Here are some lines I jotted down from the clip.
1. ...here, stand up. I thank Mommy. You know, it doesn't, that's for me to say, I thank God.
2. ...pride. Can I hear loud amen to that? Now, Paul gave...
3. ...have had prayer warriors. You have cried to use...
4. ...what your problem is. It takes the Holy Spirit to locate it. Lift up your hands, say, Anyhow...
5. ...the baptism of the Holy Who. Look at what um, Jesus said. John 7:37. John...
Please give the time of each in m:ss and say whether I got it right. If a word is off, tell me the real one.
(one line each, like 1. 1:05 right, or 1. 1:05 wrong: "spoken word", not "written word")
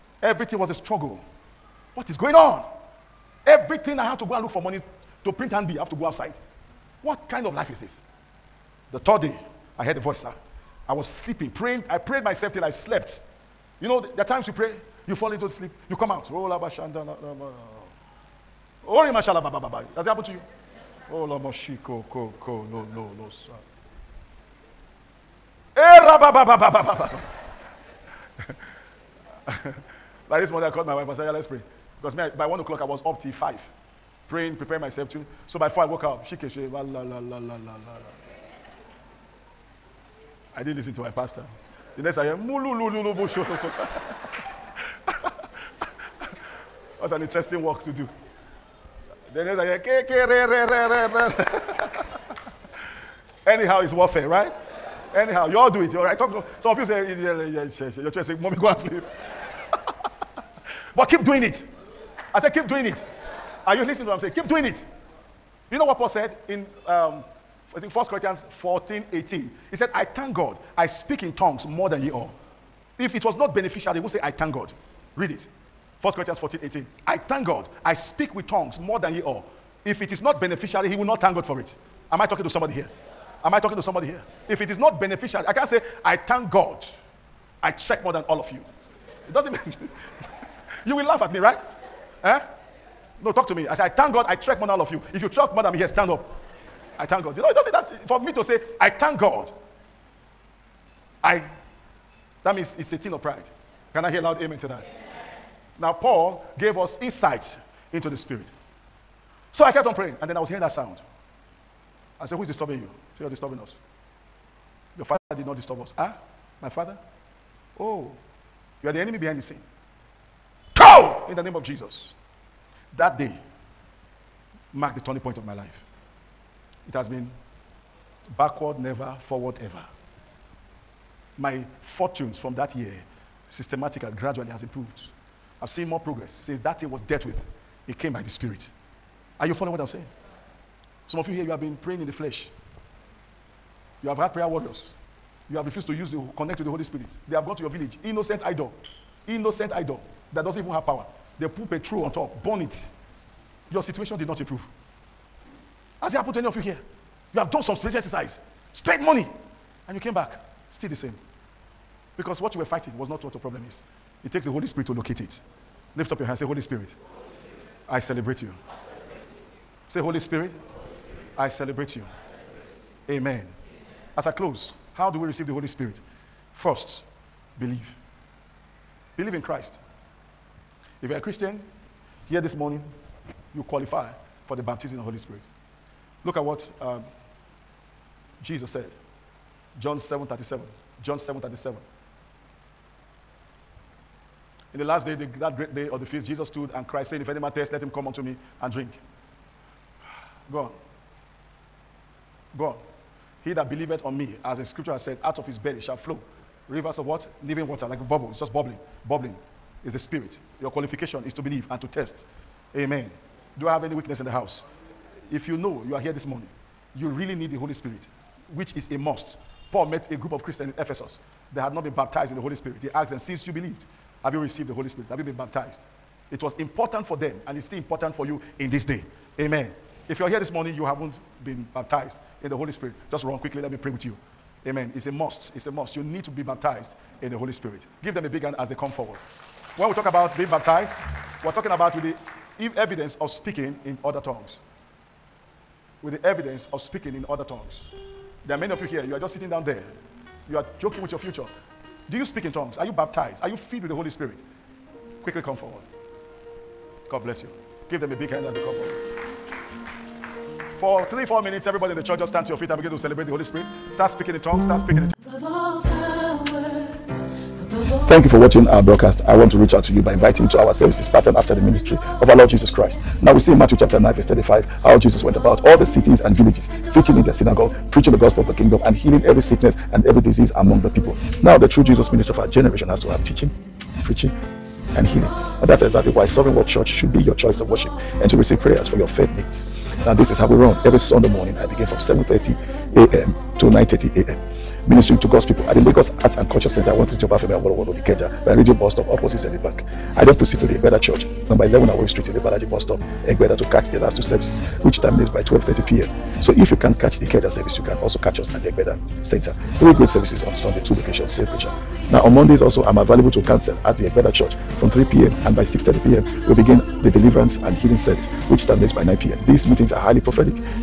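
1. 1:35 wrong: "God", not "Mommy"
2. 1:43 right
3. 2:24 wrong: "refused", not "cried"
4. 2:43 wrong: "Holy", not "Anyhow"
5. 3:04 wrong: "Spirit", not "Who".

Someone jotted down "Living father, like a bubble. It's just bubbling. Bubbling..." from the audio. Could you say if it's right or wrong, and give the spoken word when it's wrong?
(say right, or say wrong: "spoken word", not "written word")
wrong: "water", not "father".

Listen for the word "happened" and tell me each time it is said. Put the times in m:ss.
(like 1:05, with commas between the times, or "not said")
0:20, 2:36.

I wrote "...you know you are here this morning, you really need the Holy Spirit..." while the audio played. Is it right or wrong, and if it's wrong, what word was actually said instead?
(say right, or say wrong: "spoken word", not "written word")
right.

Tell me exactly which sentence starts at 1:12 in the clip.
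If it was not beneficial, they would say, I thank God.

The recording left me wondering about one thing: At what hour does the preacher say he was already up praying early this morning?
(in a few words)
1 o'clock.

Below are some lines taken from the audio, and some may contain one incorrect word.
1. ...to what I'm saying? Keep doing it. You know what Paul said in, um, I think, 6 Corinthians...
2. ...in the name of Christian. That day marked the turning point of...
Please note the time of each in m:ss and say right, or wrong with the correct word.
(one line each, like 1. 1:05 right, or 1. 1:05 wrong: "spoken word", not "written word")
1. 1:04 wrong: "1", not "6"
2. 2:01 wrong: "Jesus", not "Christian".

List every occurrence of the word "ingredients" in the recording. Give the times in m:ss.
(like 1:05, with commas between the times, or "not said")
not said.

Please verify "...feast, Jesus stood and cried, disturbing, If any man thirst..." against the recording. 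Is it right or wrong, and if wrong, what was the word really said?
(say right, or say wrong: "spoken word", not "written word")
wrong: "saying", not "disturbing".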